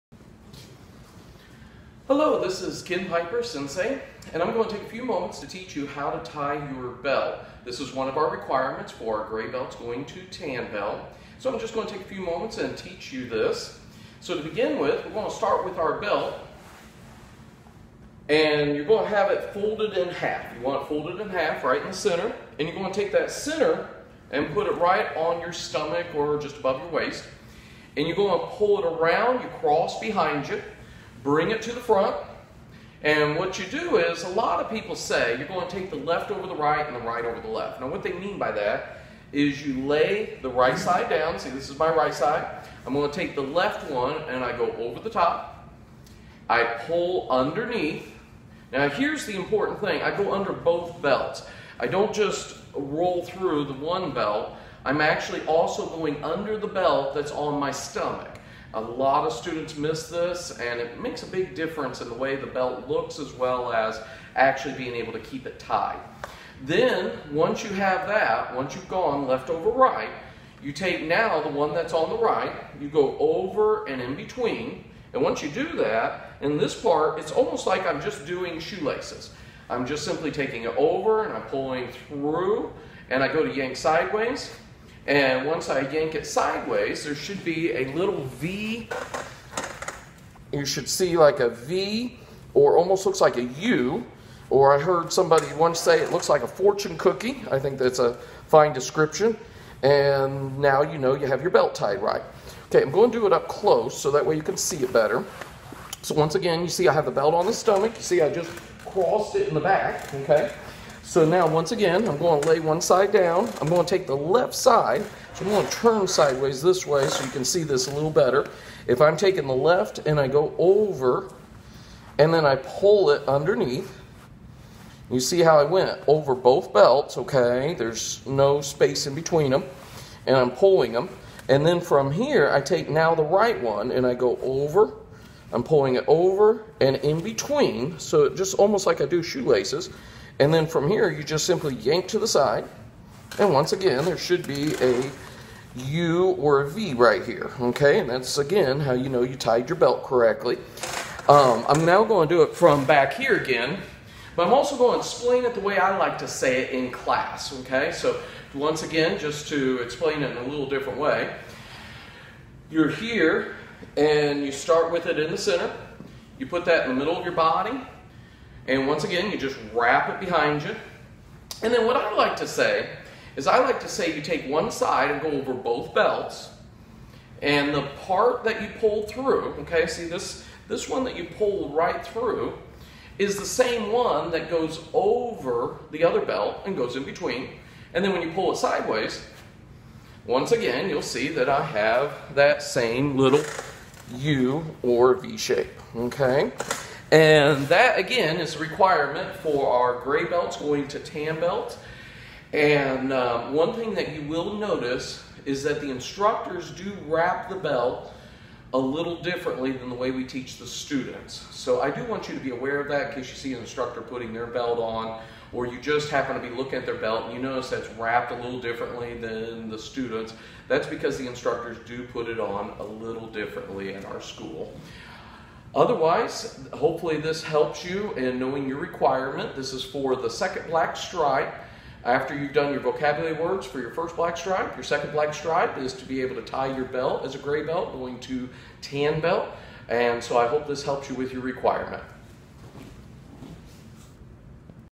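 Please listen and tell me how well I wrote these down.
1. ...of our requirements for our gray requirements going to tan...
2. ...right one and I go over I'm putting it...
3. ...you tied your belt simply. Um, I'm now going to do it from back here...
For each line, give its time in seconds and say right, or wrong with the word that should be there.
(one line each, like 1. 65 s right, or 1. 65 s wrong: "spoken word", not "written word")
1. 8 s wrong: "belts", not "requirements"
2. 133 s wrong: "pulling", not "putting"
3. 149 s wrong: "correctly", not "simply".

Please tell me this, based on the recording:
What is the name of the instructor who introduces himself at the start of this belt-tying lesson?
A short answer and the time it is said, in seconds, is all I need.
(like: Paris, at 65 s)
Ken Piper, at 2 s.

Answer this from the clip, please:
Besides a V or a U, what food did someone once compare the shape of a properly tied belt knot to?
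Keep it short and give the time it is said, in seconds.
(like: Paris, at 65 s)
fortune cookie, at 96 s.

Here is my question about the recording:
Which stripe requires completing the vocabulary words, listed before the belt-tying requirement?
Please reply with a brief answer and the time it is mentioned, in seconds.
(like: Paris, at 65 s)
first black stripe, at 233 s.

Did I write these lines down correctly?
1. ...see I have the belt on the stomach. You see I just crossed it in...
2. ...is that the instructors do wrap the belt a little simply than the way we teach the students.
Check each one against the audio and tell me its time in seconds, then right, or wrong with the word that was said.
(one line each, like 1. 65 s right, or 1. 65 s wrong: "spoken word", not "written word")
1. 106 s right
2. 205 s wrong: "differently", not "simply".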